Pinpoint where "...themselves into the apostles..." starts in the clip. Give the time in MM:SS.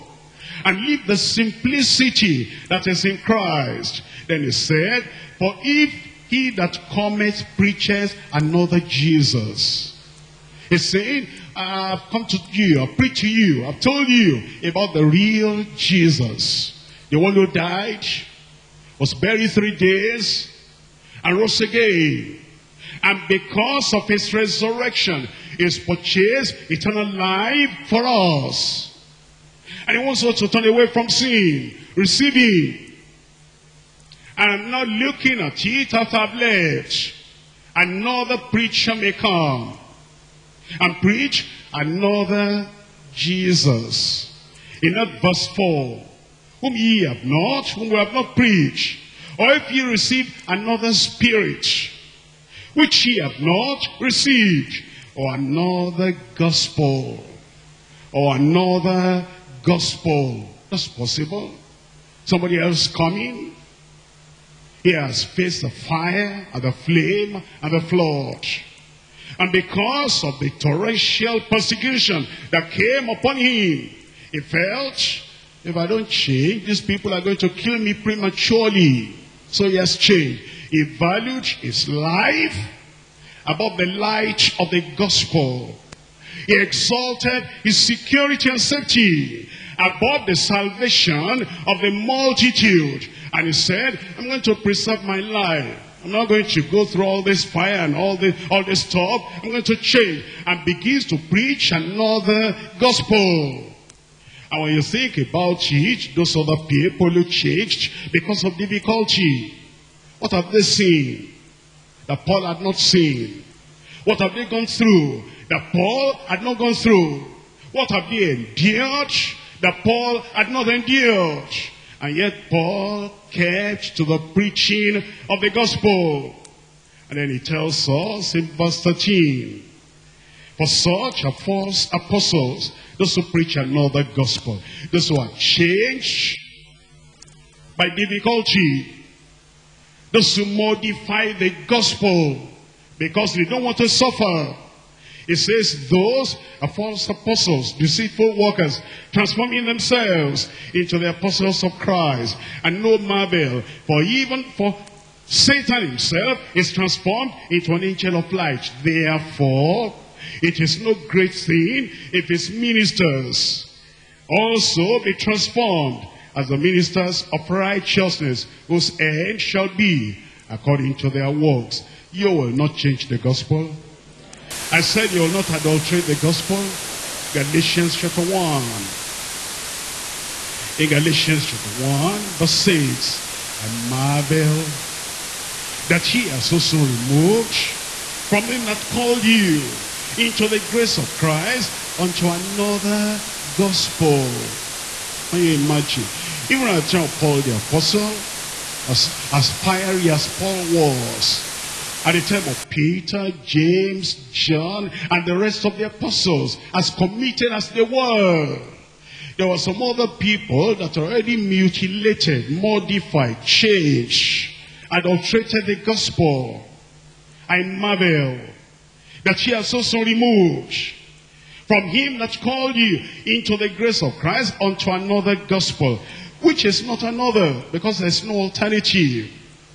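02:29.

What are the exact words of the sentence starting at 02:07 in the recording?
And then he tells us in verse 13, For such are false apostles, those who preach another gospel.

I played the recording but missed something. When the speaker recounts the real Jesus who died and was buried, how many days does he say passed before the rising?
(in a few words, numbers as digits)
3.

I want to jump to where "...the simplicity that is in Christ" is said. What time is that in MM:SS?
00:01.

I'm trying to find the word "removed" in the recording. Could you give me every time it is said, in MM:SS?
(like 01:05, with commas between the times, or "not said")
03:06, 03:40.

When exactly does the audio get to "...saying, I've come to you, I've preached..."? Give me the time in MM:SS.
00:10.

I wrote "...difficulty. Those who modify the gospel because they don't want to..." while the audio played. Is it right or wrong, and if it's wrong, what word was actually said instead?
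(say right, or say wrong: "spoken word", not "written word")
right.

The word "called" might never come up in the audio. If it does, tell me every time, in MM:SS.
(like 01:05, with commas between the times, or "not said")
03:08, 03:42.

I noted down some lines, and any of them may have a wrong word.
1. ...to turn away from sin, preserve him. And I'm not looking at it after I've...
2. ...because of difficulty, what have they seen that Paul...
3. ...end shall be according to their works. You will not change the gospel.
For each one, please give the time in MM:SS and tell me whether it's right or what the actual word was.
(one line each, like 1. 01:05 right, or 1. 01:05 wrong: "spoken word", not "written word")
1. 00:30 wrong: "receive", not "preserve"
2. 01:48 right
3. 02:49 right.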